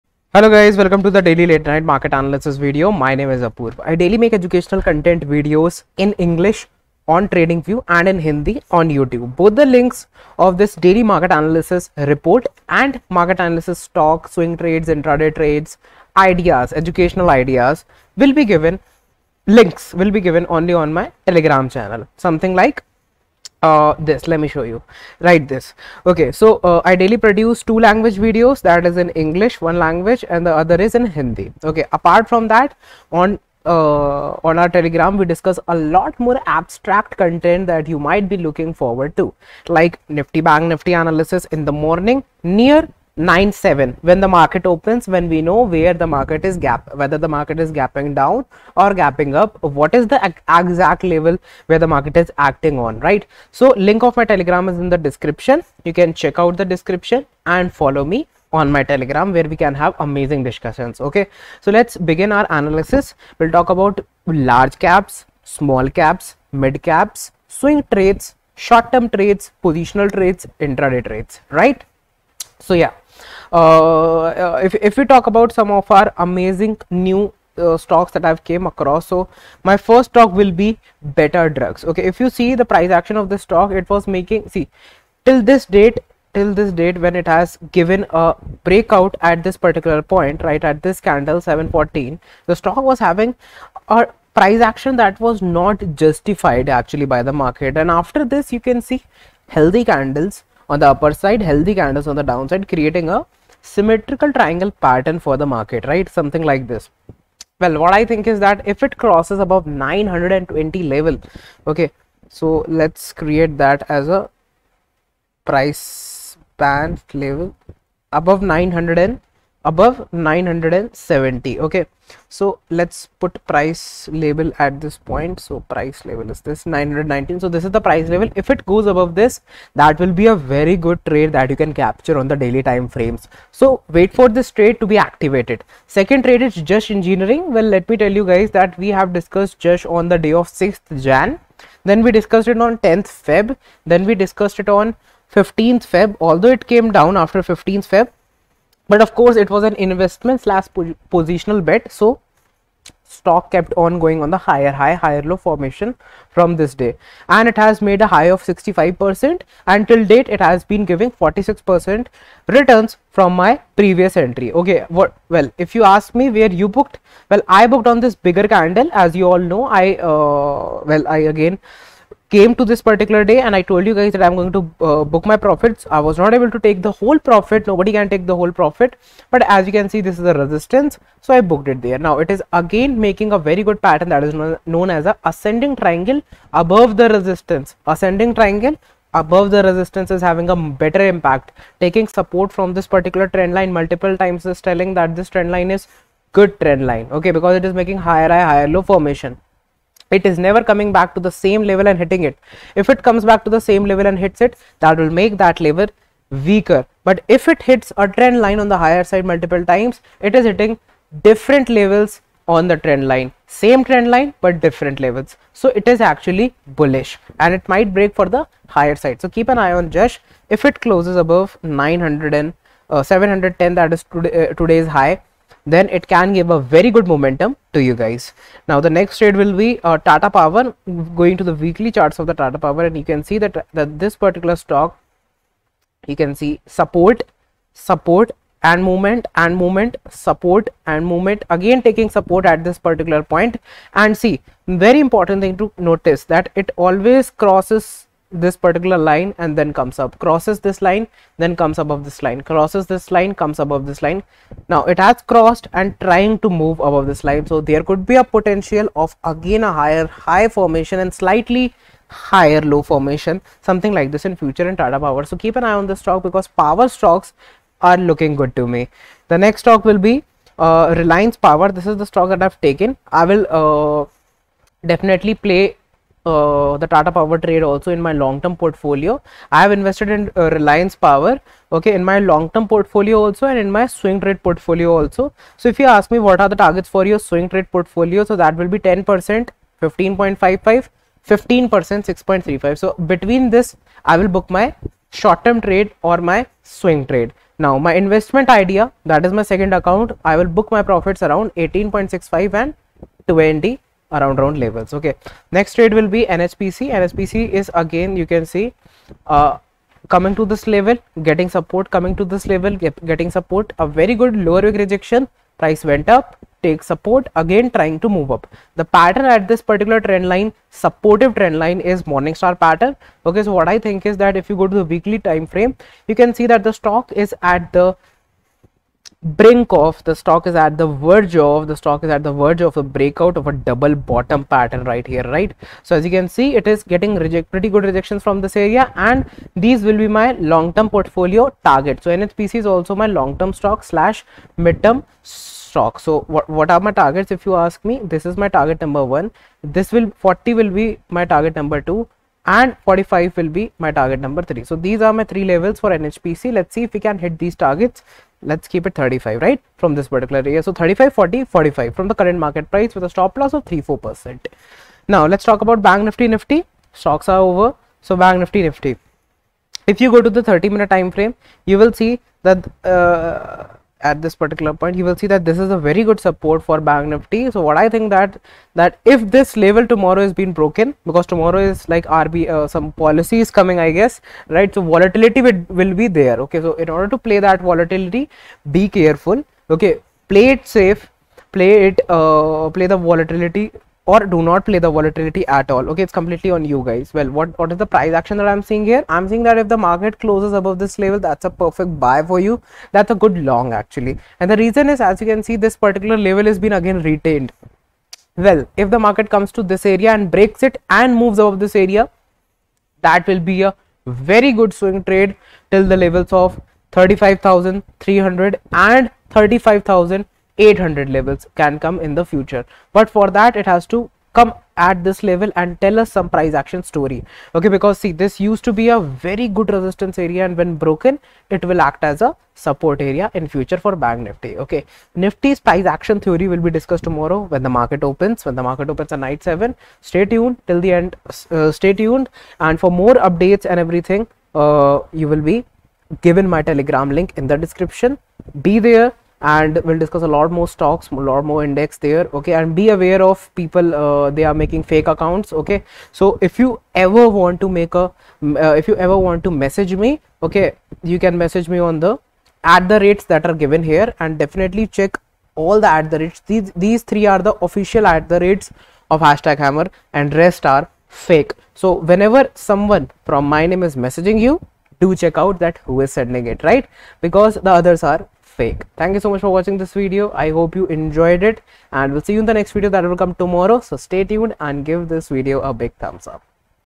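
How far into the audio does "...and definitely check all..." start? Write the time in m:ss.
7:44.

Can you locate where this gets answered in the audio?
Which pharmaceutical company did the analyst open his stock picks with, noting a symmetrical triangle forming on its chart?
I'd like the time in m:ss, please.
1:21.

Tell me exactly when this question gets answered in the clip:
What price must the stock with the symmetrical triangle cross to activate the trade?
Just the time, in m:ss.
2:06.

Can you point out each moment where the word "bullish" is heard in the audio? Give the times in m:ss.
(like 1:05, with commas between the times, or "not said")
3:36.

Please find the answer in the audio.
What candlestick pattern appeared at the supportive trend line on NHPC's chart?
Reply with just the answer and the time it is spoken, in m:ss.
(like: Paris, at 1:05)
morning star, at 5:22.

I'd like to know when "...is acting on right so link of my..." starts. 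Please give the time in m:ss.
0:52.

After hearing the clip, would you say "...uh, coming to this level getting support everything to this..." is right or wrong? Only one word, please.
wrong.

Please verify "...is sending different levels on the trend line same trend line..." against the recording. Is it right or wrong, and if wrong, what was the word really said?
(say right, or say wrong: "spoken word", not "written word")
wrong: "hitting", not "sending".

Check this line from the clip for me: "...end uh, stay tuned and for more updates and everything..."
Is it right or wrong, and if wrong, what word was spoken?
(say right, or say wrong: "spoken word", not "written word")
right.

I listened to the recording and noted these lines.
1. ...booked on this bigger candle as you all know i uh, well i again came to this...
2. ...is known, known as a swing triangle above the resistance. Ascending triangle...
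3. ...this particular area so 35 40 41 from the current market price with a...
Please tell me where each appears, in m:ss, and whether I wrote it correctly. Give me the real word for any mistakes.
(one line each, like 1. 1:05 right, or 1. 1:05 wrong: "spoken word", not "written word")
1. 2:47 right
2. 3:04 wrong: "ascending", not "swing"
3. 5:59 wrong: "45", not "41".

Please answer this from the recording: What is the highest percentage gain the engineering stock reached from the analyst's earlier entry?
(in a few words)
65 percent.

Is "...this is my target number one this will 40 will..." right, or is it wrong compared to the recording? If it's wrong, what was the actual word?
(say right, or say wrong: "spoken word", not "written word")
right.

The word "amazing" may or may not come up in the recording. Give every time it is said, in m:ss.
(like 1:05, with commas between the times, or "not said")
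0:59, 1:16.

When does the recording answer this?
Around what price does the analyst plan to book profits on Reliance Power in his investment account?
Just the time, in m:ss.
5:01.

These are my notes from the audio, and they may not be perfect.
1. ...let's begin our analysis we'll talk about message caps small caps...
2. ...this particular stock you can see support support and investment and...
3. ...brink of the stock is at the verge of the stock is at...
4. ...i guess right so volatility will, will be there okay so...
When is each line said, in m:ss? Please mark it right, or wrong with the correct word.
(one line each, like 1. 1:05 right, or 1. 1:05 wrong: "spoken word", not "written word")
1. 1:01 wrong: "large", not "message"
2. 3:53 wrong: "movement", not "investment"
3. 5:29 right
4. 6:23 right.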